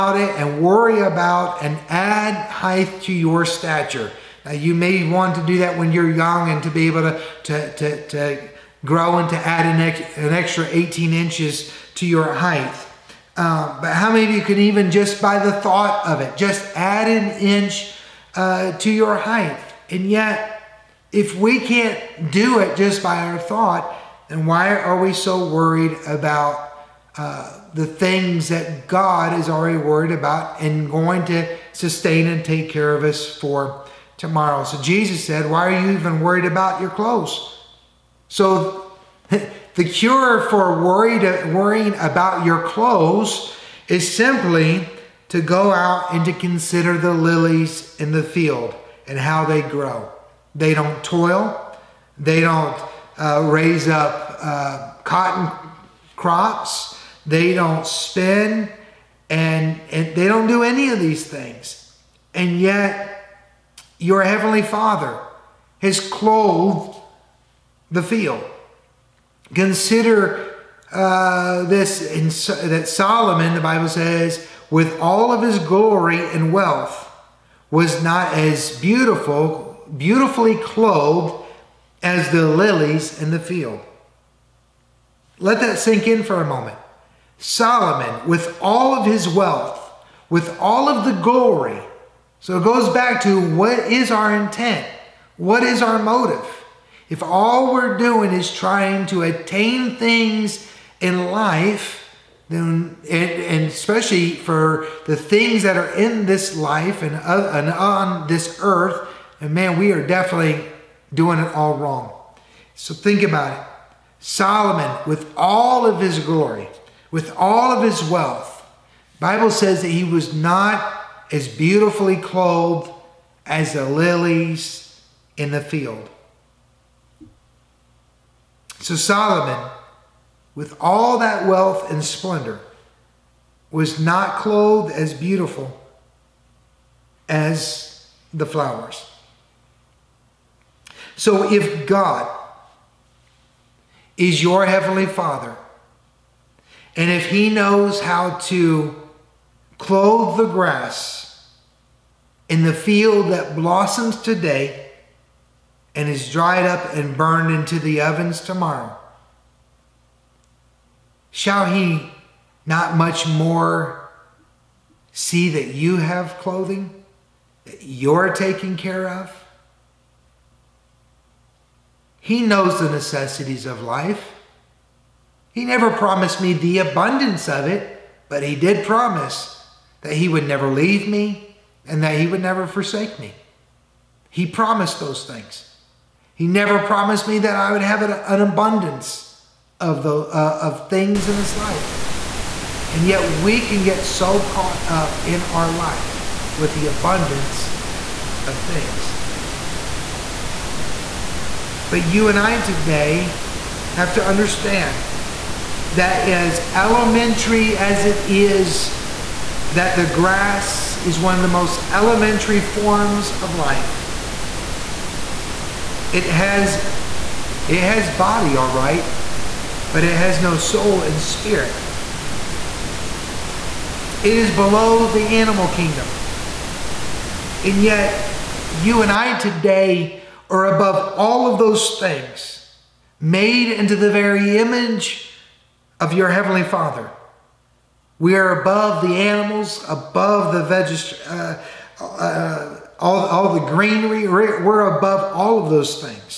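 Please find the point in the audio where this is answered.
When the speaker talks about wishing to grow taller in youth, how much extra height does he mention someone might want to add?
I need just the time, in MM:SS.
00:10.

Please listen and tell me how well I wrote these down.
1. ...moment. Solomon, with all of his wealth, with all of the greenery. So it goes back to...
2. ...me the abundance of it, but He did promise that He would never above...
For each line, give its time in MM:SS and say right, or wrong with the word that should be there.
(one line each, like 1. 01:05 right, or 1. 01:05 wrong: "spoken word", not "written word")
1. 01:26 wrong: "glory", not "greenery"
2. 02:56 wrong: "leave", not "above".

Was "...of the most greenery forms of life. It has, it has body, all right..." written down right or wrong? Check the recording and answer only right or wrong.
wrong.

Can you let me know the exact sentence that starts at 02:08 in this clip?
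So Solomon, with all that wealth and splendor, was not clothed as beautiful as the flowers.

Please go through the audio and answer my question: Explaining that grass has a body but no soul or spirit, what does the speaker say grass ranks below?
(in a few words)
the animal kingdom.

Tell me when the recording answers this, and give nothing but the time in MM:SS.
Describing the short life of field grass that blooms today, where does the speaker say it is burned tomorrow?
02:37.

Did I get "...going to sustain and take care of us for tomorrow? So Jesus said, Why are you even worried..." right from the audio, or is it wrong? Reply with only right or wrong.
right.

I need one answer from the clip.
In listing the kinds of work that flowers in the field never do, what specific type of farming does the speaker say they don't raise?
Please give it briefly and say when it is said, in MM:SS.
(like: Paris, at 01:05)
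cotton crops, at 00:55.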